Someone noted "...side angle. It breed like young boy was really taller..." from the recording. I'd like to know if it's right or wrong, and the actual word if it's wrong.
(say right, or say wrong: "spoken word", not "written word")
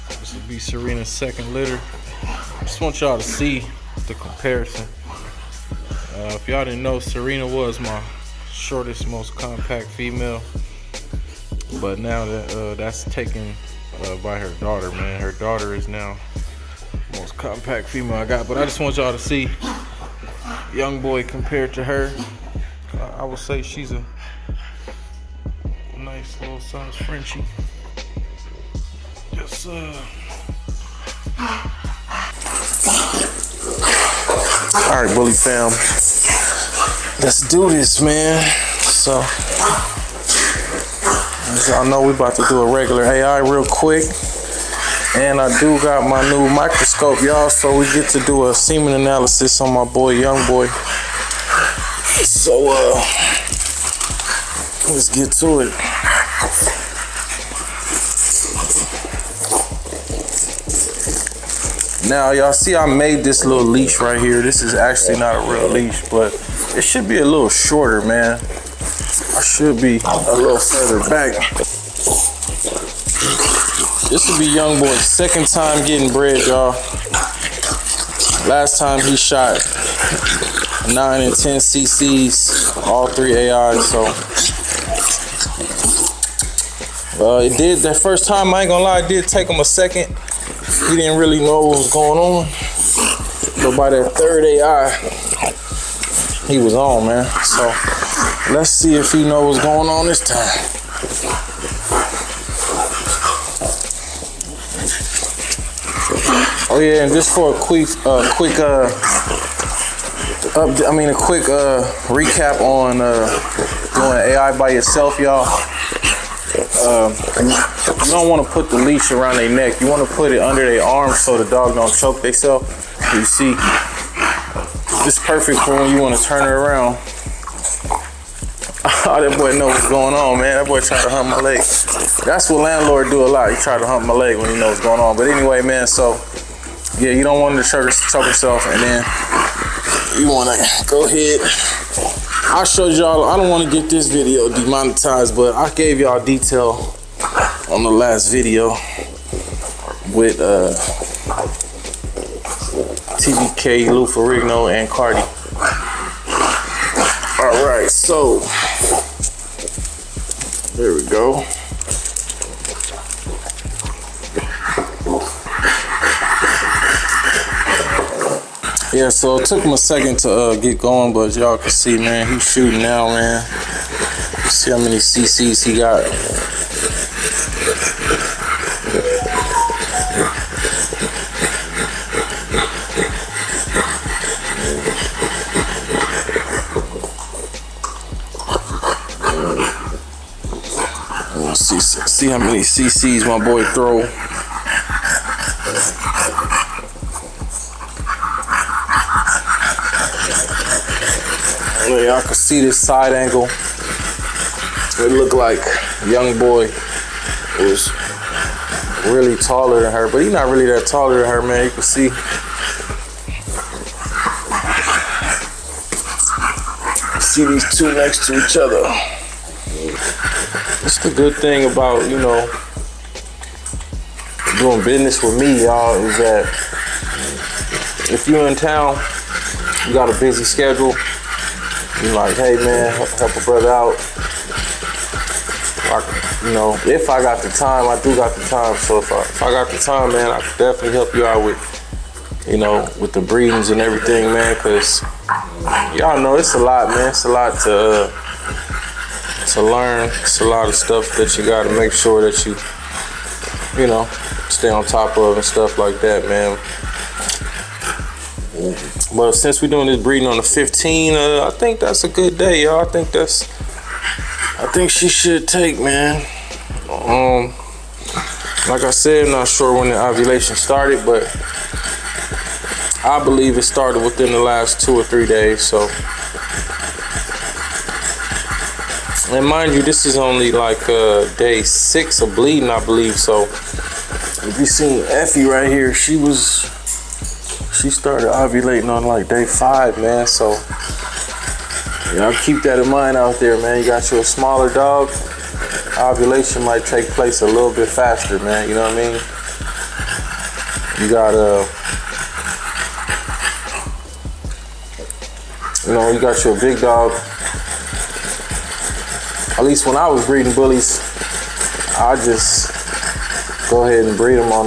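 wrong: "looked", not "breed".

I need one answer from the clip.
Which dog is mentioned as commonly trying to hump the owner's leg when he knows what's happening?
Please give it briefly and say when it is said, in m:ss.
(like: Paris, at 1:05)
Landlord, at 2:12.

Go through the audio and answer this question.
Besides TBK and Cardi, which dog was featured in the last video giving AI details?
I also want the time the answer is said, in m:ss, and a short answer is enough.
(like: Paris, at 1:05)
Lou Ferrigno, at 2:33.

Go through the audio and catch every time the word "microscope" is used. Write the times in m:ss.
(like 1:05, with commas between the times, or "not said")
0:46.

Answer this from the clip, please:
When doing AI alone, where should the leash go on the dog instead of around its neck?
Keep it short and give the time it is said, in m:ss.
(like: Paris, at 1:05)
under their arm, at 2:00.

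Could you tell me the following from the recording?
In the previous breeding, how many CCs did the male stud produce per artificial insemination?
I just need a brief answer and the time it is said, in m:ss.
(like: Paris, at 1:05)
9 and 10, at 1:20.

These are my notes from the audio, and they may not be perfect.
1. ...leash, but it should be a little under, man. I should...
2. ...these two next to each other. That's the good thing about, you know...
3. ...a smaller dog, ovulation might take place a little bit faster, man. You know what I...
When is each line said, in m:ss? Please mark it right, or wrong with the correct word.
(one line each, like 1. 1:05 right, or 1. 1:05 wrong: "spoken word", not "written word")
1. 1:05 wrong: "shorter", not "under"
2. 3:37 right
3. 4:54 right.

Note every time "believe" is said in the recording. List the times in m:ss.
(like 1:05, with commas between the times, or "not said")
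4:33, 4:42.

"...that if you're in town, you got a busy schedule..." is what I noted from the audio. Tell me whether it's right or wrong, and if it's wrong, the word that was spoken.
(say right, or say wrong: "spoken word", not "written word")
right.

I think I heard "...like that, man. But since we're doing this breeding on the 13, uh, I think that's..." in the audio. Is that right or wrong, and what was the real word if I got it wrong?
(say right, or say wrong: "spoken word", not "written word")
wrong: "15", not "13".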